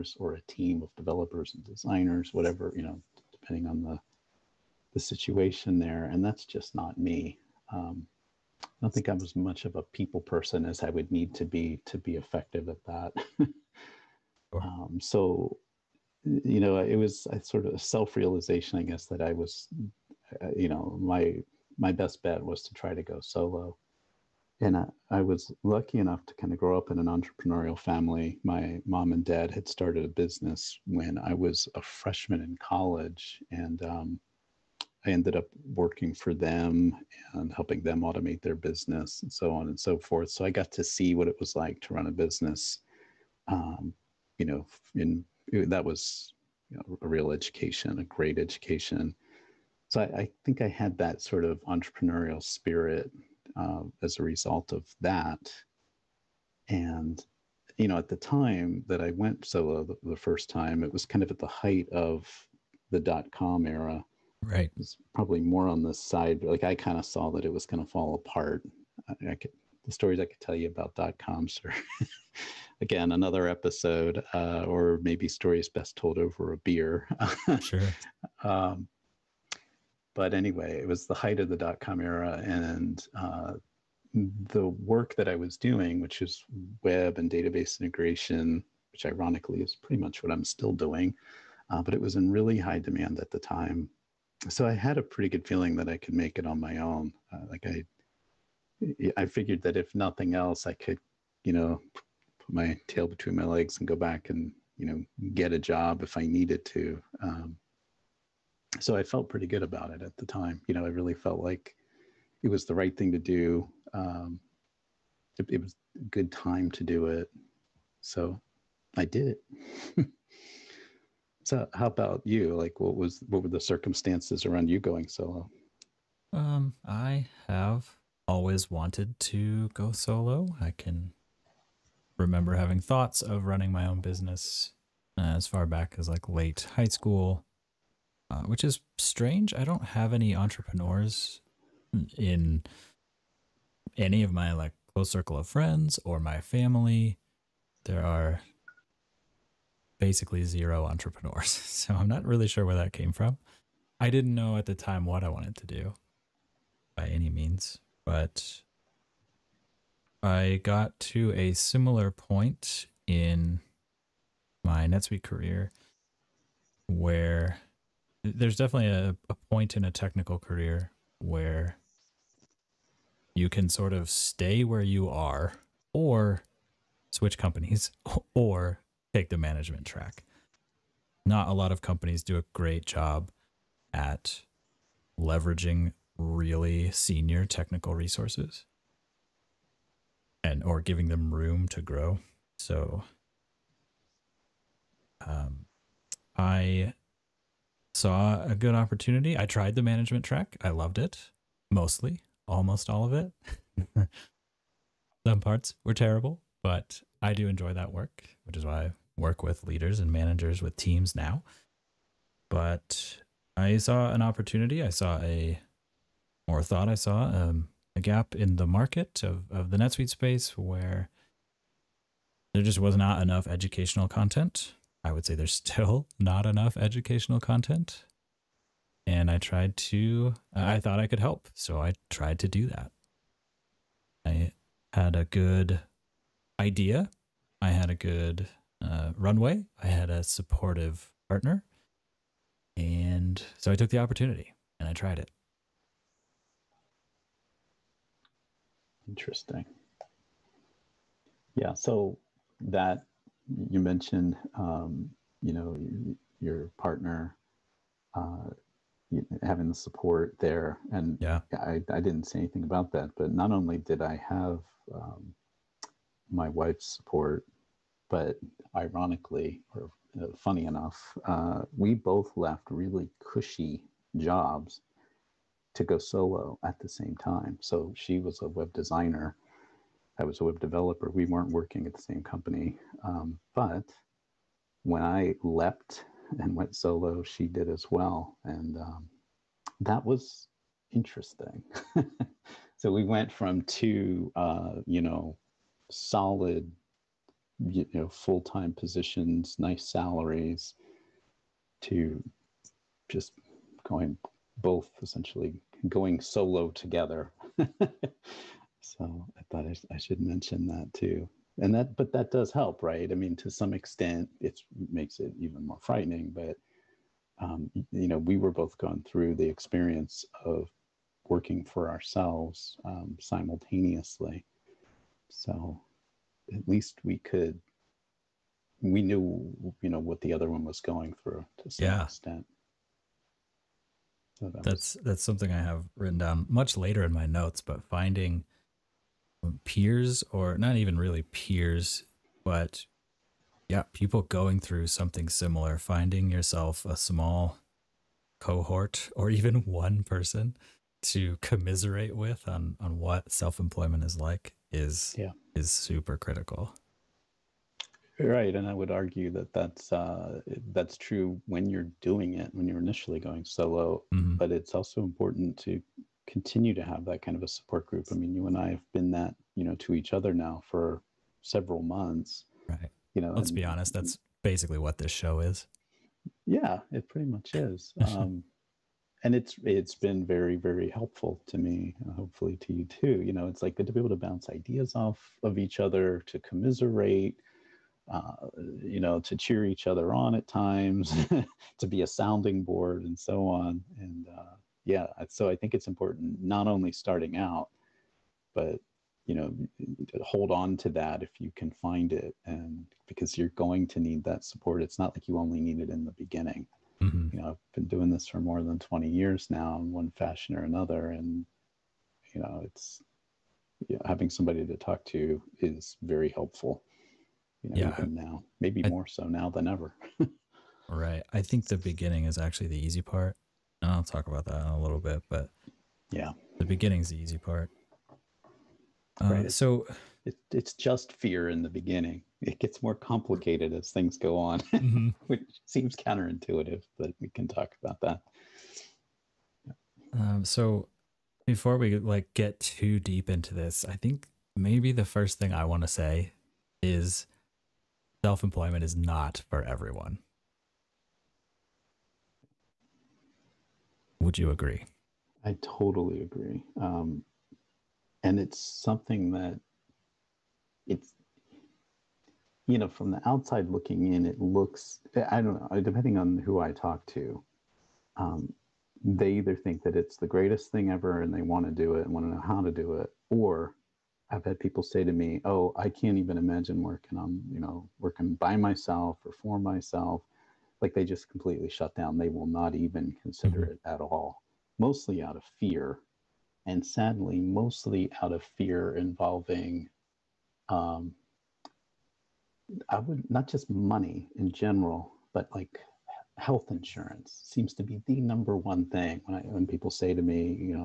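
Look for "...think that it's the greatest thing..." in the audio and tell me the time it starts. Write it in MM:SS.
07:49.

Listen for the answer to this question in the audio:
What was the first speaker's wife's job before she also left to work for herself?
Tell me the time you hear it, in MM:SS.
04:38.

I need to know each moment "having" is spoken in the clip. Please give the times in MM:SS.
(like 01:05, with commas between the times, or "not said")
02:12, 04:19, 06:54.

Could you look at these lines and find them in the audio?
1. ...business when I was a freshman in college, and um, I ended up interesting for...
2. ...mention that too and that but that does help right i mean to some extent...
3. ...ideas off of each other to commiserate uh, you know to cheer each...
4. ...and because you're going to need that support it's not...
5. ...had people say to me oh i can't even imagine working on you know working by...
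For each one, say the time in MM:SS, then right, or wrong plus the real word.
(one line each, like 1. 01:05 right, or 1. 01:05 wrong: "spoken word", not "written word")
1. 00:30 wrong: "working", not "interesting"
2. 05:10 right
3. 06:24 right
4. 06:42 right
5. 07:54 right.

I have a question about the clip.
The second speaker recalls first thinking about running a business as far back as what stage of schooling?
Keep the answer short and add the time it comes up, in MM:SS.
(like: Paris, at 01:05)
late high school, at 02:16.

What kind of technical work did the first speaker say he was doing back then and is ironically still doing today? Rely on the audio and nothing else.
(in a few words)
web and database integration.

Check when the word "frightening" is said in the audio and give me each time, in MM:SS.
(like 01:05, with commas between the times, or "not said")
05:15.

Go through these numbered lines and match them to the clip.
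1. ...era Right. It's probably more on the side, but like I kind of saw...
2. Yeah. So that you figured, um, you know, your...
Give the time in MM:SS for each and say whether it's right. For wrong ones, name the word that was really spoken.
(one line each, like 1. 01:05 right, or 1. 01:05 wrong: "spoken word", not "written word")
1. 01:03 right
2. 04:11 wrong: "mentioned", not "figured".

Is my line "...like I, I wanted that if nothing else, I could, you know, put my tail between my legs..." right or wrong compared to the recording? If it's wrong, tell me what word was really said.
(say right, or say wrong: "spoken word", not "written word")
wrong: "figured", not "wanted".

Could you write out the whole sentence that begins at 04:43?
Um, but when I leapt and went solo, she did as well.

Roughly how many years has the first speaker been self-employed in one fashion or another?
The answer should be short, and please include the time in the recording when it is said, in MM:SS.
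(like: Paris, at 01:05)
more than 20, at 06:48.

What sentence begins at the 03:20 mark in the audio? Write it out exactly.
I loved it mostly, almost all of it.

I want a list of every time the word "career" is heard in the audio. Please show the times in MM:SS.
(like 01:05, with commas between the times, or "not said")
02:45, 02:50.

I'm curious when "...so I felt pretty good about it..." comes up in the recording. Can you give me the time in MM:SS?
01:48.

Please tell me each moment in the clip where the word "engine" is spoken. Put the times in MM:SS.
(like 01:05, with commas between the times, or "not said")
not said.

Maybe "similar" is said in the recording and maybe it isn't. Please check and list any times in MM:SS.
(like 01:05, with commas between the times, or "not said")
02:41, 05:45.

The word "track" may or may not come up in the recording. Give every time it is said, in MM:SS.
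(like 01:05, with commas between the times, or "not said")
02:59, 03:20.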